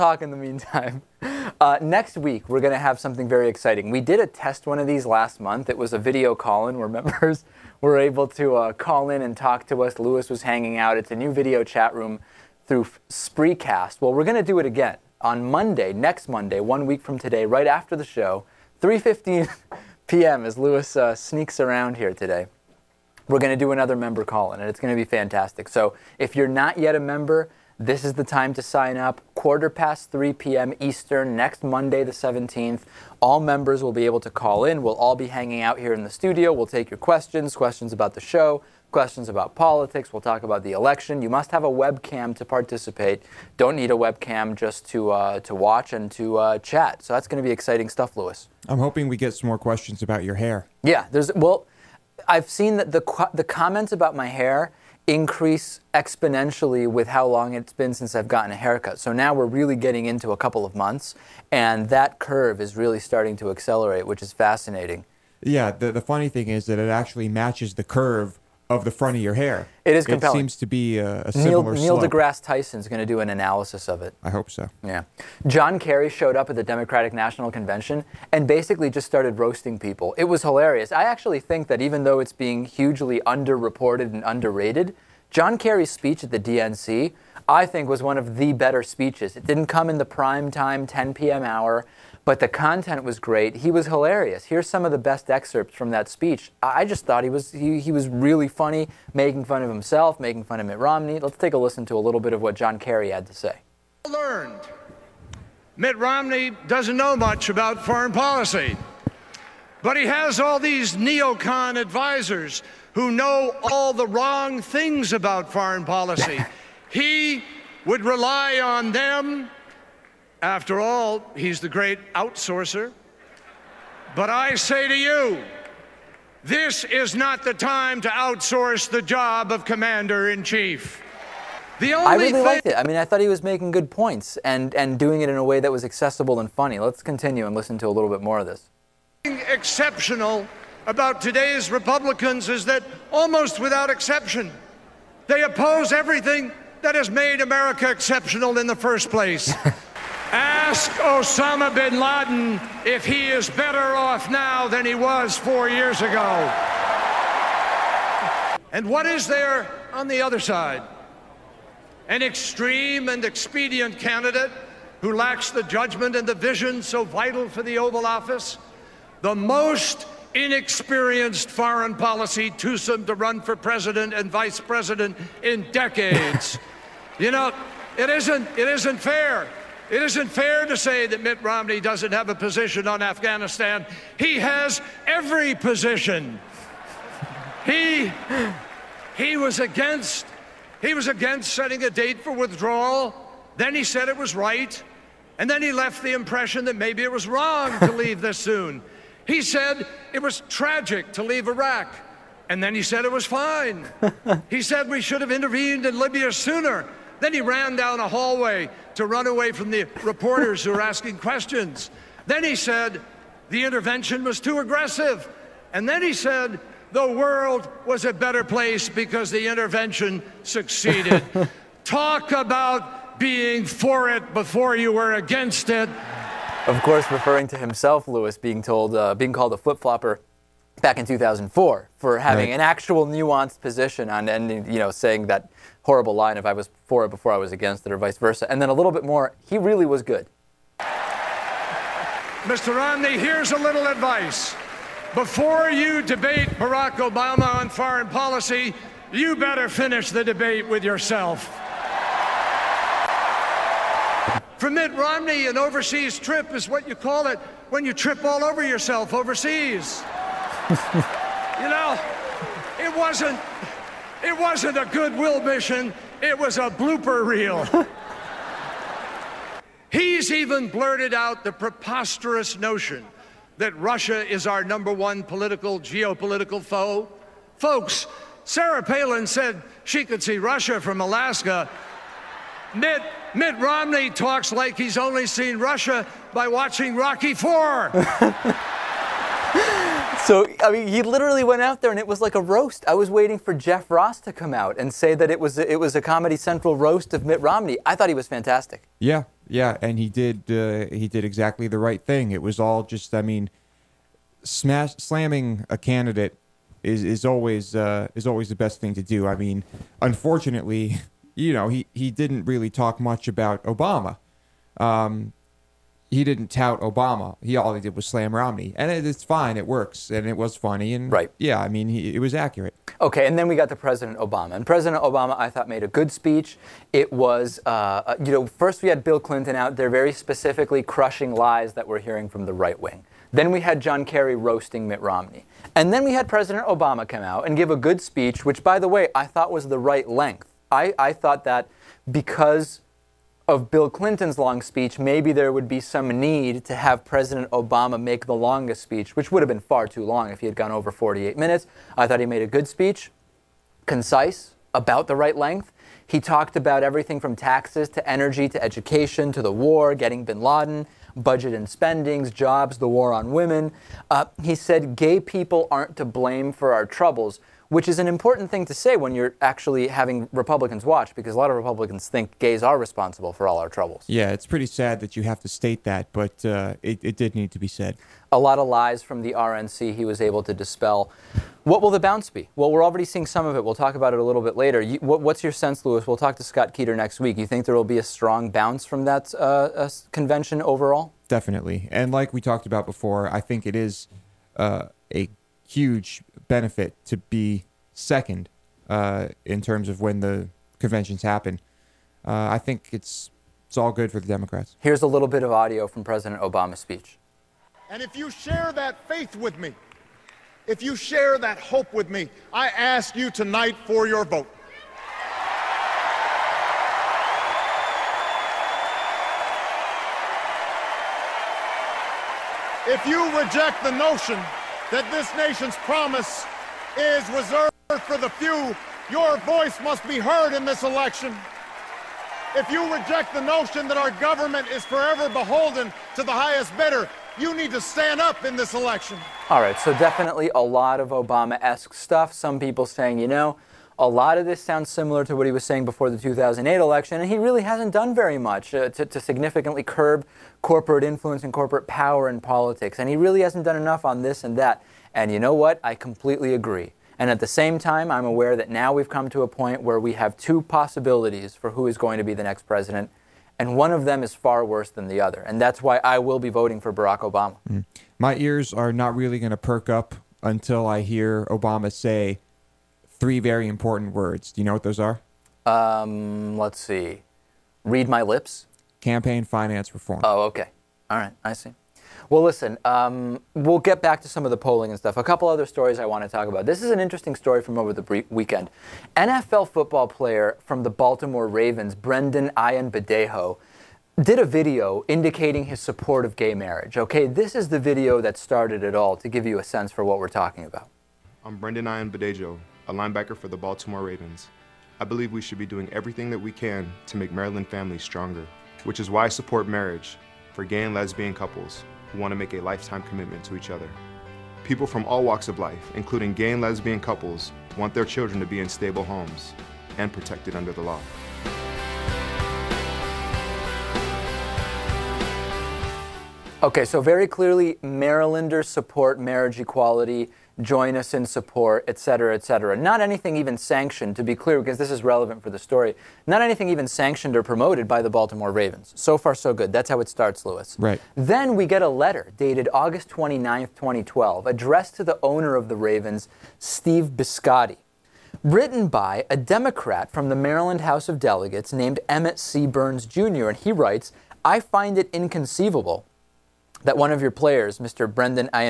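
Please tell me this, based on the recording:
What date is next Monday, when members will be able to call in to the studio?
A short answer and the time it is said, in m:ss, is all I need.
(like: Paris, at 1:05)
the 17th, at 0:32.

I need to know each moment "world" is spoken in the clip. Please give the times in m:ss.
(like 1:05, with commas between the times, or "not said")
3:37.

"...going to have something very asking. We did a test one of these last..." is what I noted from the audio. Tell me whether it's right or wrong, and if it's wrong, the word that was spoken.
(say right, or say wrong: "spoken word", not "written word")
wrong: "exciting", not "asking".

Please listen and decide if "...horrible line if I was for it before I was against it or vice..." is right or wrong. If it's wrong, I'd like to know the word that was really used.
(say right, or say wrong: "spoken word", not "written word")
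right.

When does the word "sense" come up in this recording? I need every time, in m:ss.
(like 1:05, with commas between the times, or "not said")
6:25, 8:19.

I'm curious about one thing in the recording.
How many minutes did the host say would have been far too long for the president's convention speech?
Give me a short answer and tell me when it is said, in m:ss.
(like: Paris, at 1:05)
48 minutes, at 5:50.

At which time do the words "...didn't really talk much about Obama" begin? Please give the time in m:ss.
5:12.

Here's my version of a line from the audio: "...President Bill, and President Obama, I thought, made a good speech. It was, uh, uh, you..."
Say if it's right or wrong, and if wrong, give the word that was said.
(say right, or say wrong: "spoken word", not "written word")
wrong: "Obama", not "Bill".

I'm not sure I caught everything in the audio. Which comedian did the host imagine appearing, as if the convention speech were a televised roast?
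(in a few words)
Jeff Ross.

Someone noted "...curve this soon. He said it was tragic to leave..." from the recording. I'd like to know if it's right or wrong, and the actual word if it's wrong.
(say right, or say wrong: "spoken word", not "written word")
wrong: "leave", not "curve".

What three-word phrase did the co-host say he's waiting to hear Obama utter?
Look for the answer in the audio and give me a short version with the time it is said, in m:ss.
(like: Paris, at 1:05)
Campaign finance reform, at 7:58.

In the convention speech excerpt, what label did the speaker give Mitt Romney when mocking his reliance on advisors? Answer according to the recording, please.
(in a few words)
the great outsourcer.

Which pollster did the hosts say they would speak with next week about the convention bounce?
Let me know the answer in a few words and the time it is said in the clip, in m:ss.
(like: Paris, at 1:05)
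Scott Keeter, at 6:26.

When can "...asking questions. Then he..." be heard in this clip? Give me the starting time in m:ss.
3:30.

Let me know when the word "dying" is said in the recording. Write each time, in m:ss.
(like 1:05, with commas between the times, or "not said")
not said.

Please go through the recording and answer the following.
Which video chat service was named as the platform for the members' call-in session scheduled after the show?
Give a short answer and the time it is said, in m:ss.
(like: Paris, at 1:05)
Spreecast, at 0:13.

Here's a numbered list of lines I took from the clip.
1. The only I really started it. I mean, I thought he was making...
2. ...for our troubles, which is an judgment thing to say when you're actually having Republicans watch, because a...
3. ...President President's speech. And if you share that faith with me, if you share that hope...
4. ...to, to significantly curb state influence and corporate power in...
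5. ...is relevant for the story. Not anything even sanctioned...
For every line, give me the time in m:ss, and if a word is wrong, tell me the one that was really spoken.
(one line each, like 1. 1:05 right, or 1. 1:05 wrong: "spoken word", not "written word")
1. 2:11 wrong: "liked", not "started"
2. 6:06 wrong: "important", not "judgment"
3. 6:46 wrong: "Obama", not "President"
4. 7:28 wrong: "corporate", not "state"
5. 8:54 right.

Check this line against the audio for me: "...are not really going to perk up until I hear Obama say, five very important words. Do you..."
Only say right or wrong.
wrong.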